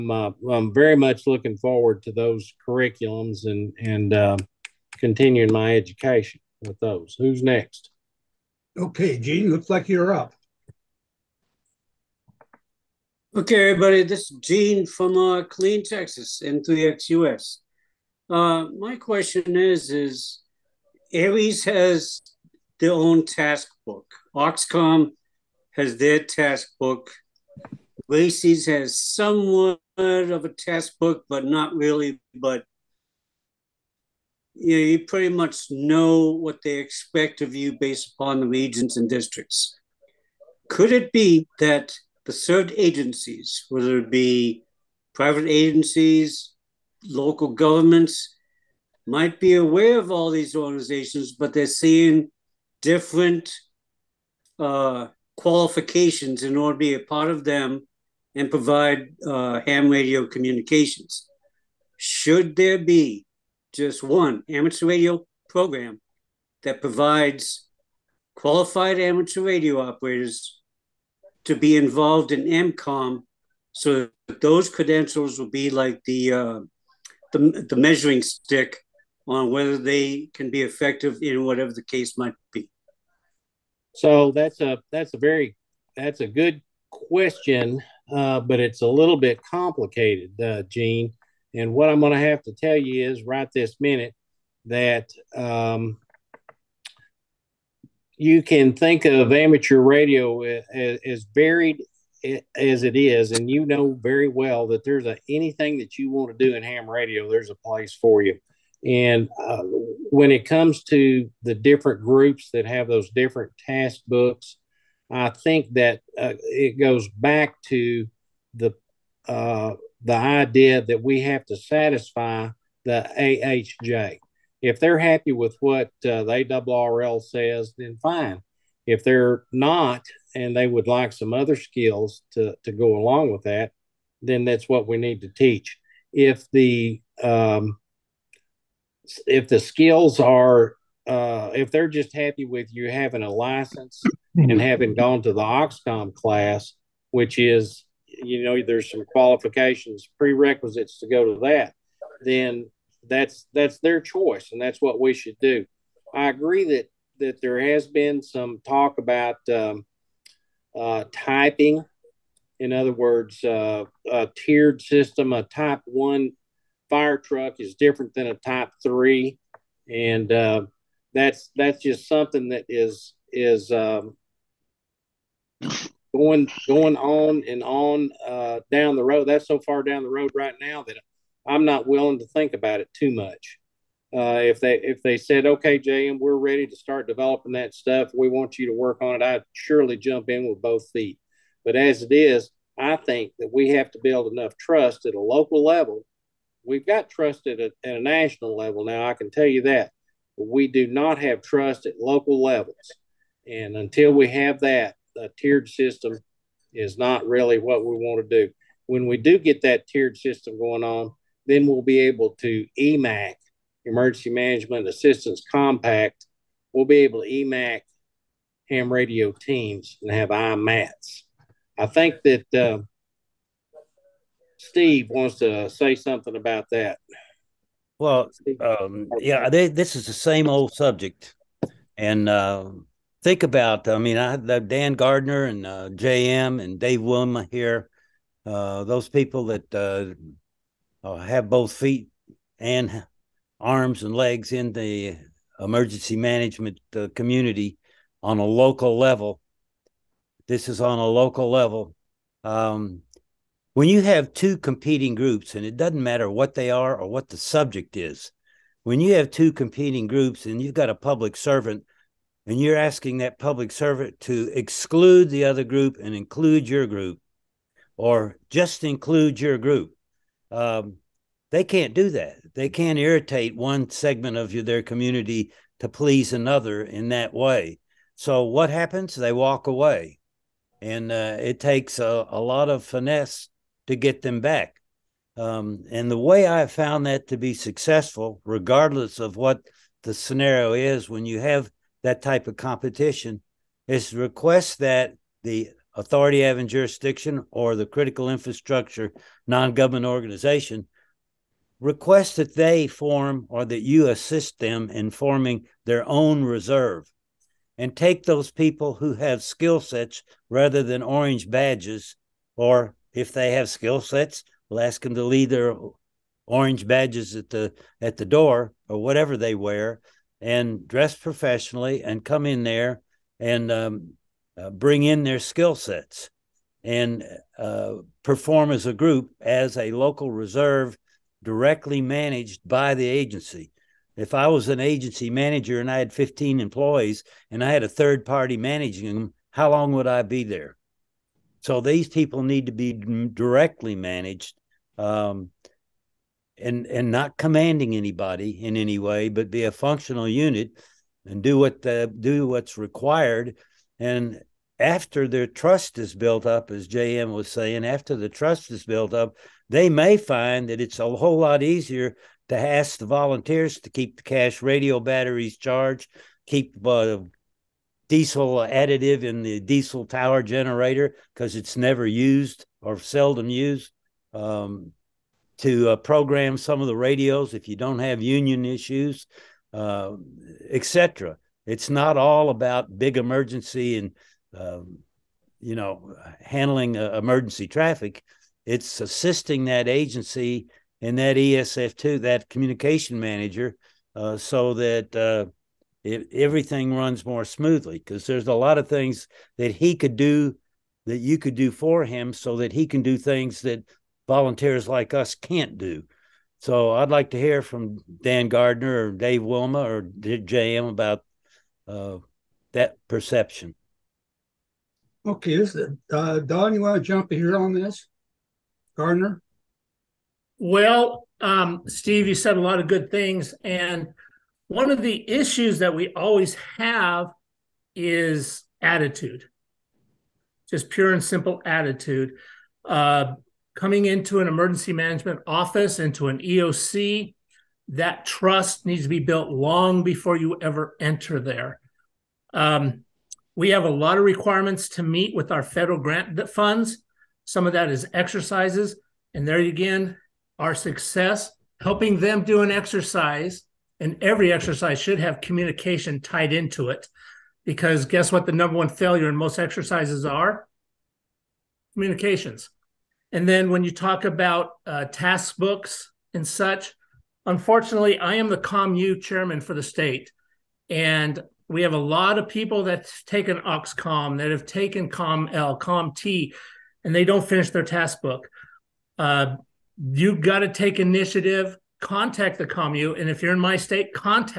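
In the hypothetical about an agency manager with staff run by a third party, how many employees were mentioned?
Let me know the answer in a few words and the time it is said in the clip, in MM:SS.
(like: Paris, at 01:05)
15, at 05:36.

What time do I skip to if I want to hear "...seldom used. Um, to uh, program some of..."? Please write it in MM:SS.
06:12.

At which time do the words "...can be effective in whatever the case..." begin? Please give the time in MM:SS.
01:20.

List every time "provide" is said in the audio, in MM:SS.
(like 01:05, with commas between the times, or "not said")
00:58, 01:06.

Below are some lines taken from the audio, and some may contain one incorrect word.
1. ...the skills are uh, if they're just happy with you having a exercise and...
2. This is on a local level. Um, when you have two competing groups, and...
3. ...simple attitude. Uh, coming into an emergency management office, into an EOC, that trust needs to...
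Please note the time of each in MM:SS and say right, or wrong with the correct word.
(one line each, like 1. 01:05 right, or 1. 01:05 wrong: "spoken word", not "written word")
1. 02:19 wrong: "license", not "exercise"
2. 04:10 right
3. 07:11 right.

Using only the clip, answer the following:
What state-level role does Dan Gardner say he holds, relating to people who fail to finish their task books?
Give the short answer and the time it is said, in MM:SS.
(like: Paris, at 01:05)
COMU chairman, at 07:48.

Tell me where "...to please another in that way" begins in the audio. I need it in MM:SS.
04:35.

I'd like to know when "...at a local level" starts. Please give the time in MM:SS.
03:15.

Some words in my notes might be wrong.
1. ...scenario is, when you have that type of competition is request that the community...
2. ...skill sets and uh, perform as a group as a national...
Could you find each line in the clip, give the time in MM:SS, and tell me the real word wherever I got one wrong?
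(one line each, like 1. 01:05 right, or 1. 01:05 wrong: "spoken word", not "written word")
1. 04:50 wrong: "authority", not "community"
2. 05:25 wrong: "local", not "national".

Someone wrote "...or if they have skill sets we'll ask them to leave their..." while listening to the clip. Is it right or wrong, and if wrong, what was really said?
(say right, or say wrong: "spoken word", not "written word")
right.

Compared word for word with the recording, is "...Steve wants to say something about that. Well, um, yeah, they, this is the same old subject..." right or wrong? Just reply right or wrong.
right.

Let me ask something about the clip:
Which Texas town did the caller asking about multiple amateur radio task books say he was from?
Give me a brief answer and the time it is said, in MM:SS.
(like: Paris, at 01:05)
Clean, at 00:15.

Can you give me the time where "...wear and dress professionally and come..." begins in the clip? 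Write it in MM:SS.
05:19.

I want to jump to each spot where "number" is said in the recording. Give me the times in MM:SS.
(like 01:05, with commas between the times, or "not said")
07:38.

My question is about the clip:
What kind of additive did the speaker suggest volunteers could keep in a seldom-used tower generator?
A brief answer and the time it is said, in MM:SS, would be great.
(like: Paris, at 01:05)
Diesel additive, at 06:08.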